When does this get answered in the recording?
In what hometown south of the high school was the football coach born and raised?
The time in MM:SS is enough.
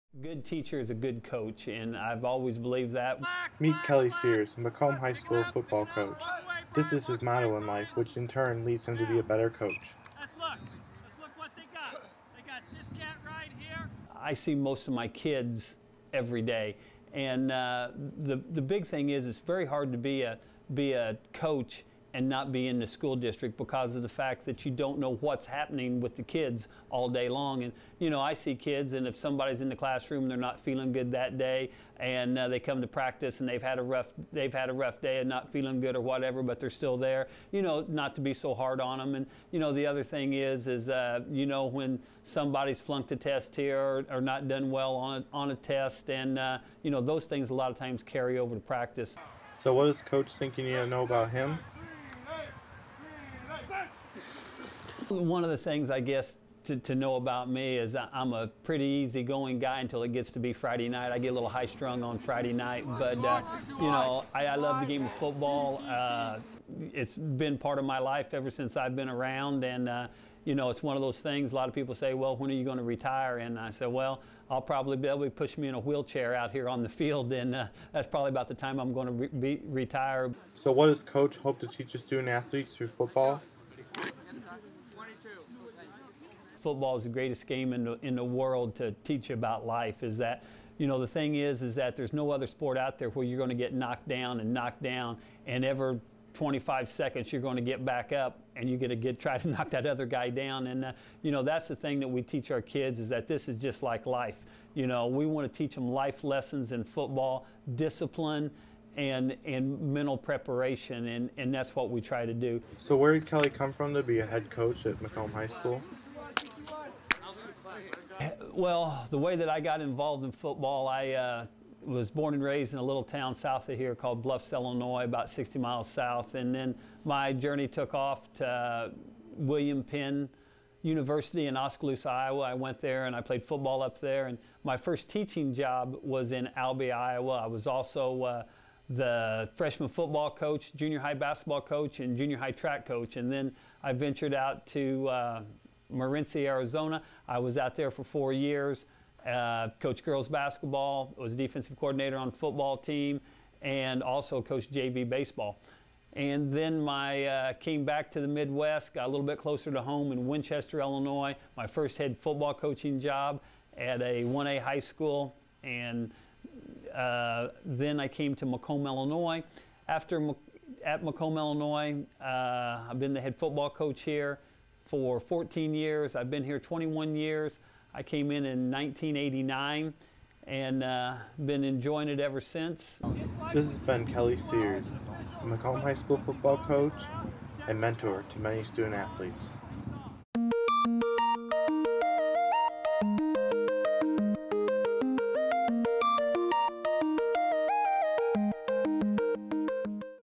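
02:04.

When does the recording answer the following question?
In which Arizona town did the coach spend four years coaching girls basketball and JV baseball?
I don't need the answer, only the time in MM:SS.
02:25.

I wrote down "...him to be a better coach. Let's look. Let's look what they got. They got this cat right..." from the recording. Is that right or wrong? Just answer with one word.
right.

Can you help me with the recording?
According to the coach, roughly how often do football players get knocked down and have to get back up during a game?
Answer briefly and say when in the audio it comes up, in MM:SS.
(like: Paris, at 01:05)
every 25 seconds, at 01:35.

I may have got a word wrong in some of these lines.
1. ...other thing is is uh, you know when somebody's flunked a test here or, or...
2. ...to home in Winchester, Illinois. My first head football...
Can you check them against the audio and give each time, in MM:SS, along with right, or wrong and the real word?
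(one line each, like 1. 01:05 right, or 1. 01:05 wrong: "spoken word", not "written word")
1. 00:39 right
2. 02:39 right.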